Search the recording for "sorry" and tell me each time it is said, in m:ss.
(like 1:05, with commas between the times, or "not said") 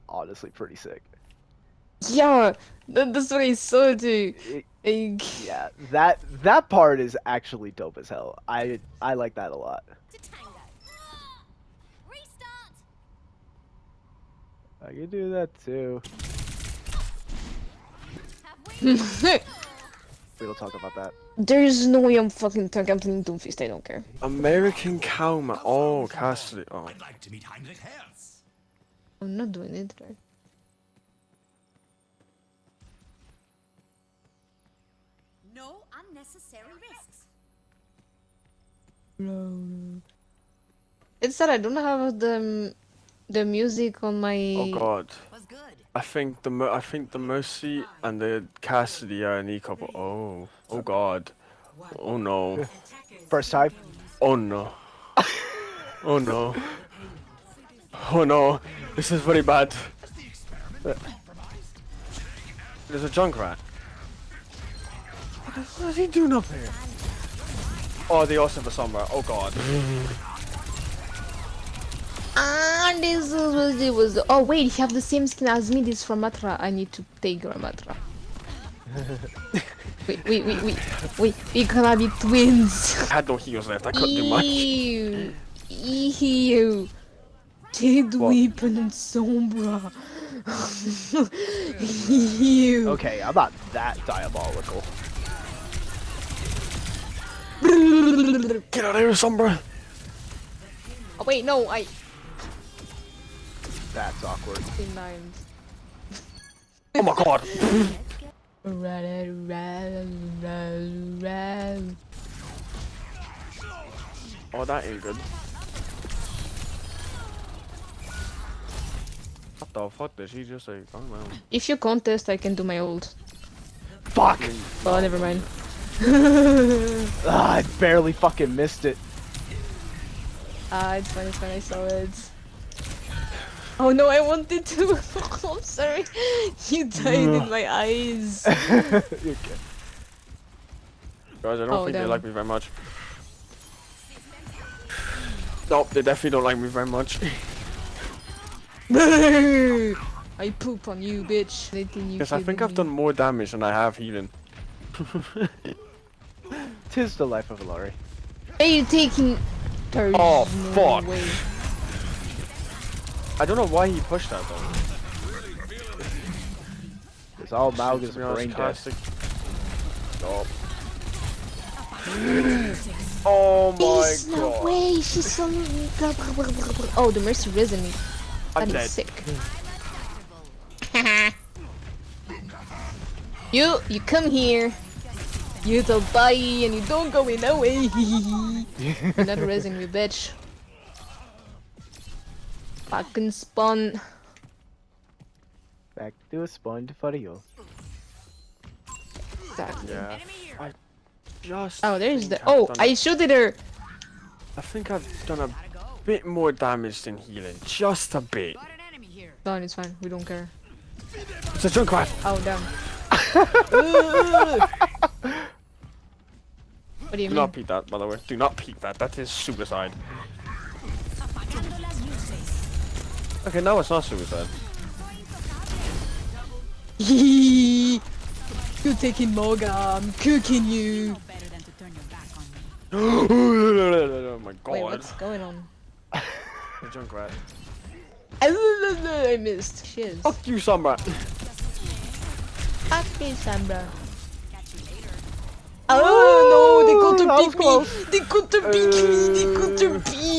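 2:15.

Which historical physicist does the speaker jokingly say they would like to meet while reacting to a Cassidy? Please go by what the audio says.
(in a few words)
Heinrich Herz.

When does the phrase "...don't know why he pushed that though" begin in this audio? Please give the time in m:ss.
2:43.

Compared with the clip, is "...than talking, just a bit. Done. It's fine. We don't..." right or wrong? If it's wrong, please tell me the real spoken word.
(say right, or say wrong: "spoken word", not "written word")
wrong: "healing", not "talking".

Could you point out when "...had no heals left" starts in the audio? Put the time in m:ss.
1:23.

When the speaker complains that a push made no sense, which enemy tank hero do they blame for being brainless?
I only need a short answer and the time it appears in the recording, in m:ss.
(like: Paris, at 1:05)
Mauga, at 2:47.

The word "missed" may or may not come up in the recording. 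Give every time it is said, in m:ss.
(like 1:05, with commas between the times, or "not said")
2:08, 3:59.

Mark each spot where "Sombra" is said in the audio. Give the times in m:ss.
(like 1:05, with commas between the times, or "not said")
1:08, 1:28, 1:39.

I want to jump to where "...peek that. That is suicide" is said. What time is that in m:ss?
3:38.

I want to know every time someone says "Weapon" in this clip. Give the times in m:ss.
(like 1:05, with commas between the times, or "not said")
1:28.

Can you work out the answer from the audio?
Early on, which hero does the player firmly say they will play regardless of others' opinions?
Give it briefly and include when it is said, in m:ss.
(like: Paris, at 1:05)
Doomfist, at 0:23.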